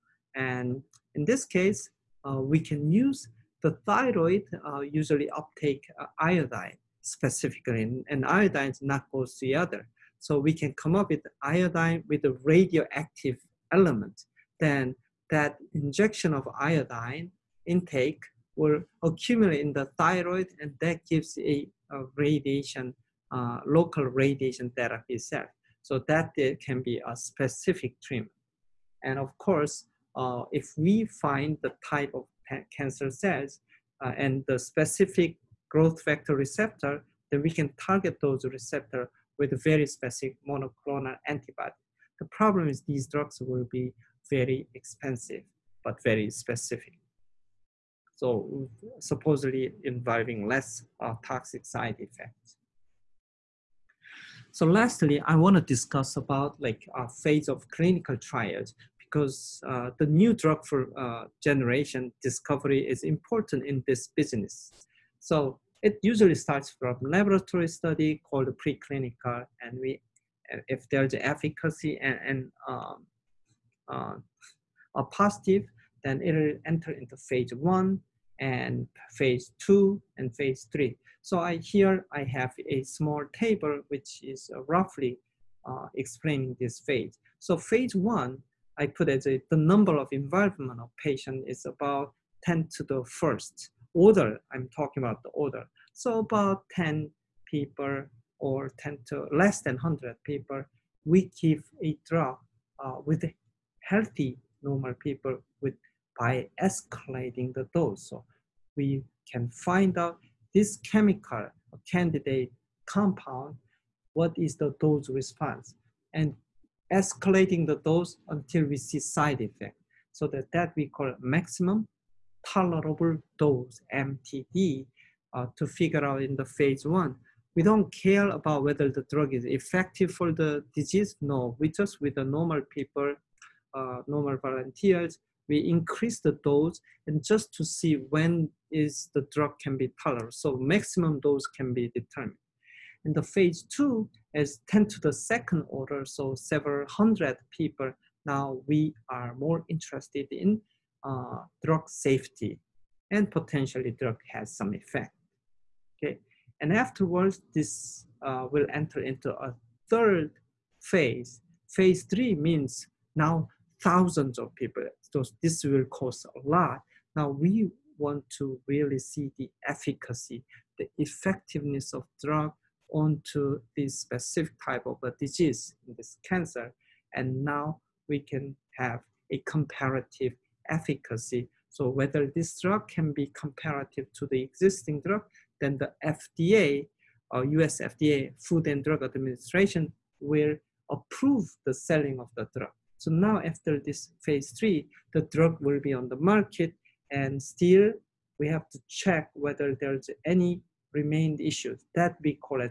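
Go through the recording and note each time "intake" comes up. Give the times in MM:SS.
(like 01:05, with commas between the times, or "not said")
00:17.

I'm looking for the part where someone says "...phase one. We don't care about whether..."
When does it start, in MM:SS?
02:06.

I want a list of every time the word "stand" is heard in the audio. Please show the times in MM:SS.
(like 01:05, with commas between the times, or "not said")
not said.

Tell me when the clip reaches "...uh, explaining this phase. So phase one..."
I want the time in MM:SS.
01:25.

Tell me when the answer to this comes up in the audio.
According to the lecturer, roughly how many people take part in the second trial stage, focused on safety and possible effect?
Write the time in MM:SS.
02:26.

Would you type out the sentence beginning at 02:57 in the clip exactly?
And now we can have a comparative efficacy.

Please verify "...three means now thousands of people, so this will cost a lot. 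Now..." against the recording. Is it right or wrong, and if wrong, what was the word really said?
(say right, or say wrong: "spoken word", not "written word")
right.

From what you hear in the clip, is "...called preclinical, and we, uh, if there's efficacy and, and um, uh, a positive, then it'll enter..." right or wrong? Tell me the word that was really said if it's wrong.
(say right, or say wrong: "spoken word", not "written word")
right.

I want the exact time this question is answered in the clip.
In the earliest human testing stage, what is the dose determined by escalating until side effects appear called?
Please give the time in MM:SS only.
02:01.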